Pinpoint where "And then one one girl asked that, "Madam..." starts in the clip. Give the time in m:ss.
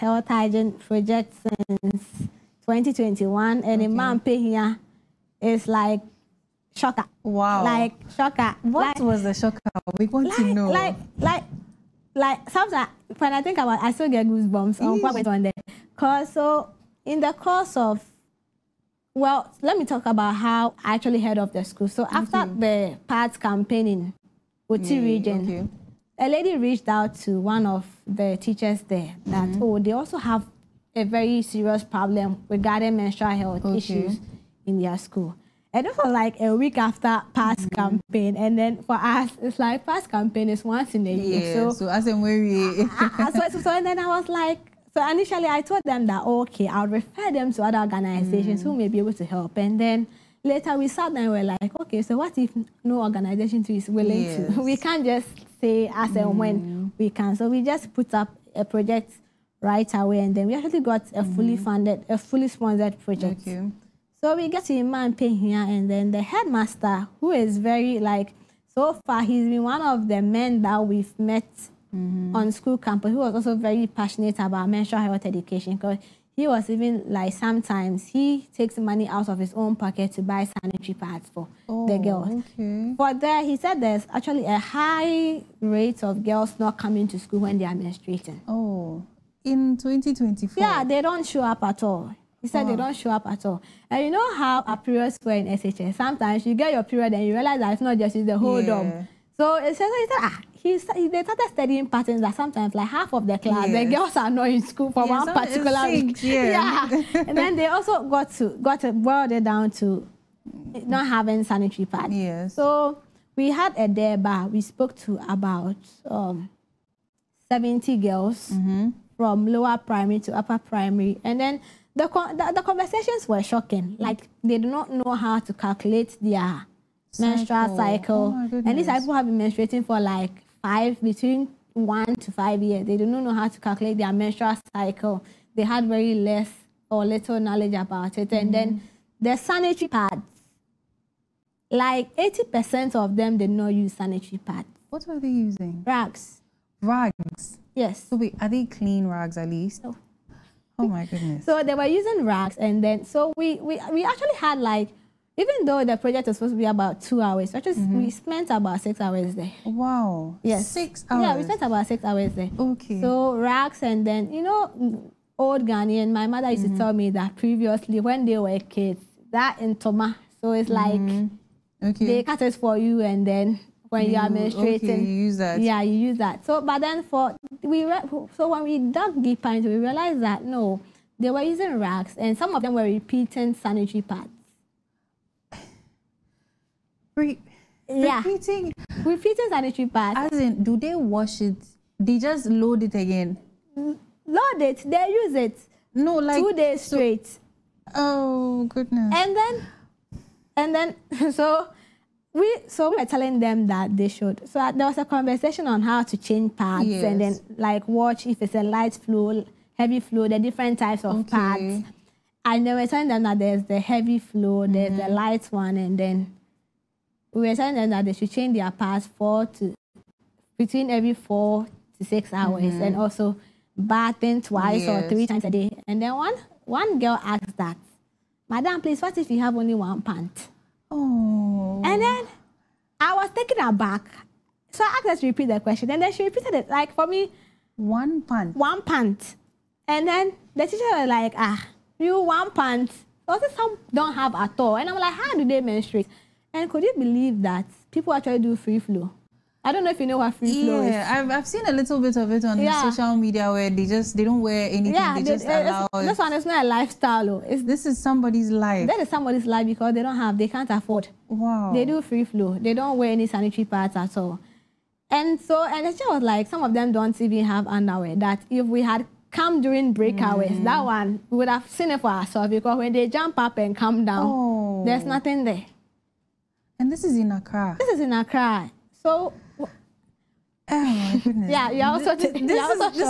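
3:45.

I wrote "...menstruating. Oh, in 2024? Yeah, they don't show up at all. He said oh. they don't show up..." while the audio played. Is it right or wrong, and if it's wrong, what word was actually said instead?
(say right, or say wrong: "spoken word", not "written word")
right.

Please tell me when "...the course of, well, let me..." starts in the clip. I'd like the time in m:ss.
0:17.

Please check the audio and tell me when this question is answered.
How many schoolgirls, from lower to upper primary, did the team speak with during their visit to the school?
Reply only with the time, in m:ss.
1:57.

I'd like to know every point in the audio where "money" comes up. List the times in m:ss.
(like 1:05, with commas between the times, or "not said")
1:18.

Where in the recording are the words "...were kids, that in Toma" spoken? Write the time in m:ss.
2:48.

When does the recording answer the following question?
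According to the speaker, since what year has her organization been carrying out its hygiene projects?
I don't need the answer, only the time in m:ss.
0:02.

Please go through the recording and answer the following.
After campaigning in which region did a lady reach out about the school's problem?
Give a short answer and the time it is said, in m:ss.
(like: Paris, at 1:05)
Oti, at 0:24.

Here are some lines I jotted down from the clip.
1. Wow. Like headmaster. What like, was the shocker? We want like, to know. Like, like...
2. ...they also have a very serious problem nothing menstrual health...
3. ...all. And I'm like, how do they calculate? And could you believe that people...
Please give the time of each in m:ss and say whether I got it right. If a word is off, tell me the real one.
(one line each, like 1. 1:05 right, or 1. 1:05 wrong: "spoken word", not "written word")
1. 0:07 wrong: "shocker", not "headmaster"
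2. 0:29 wrong: "regarding", not "nothing"
3. 4:04 wrong: "menstruate", not "calculate".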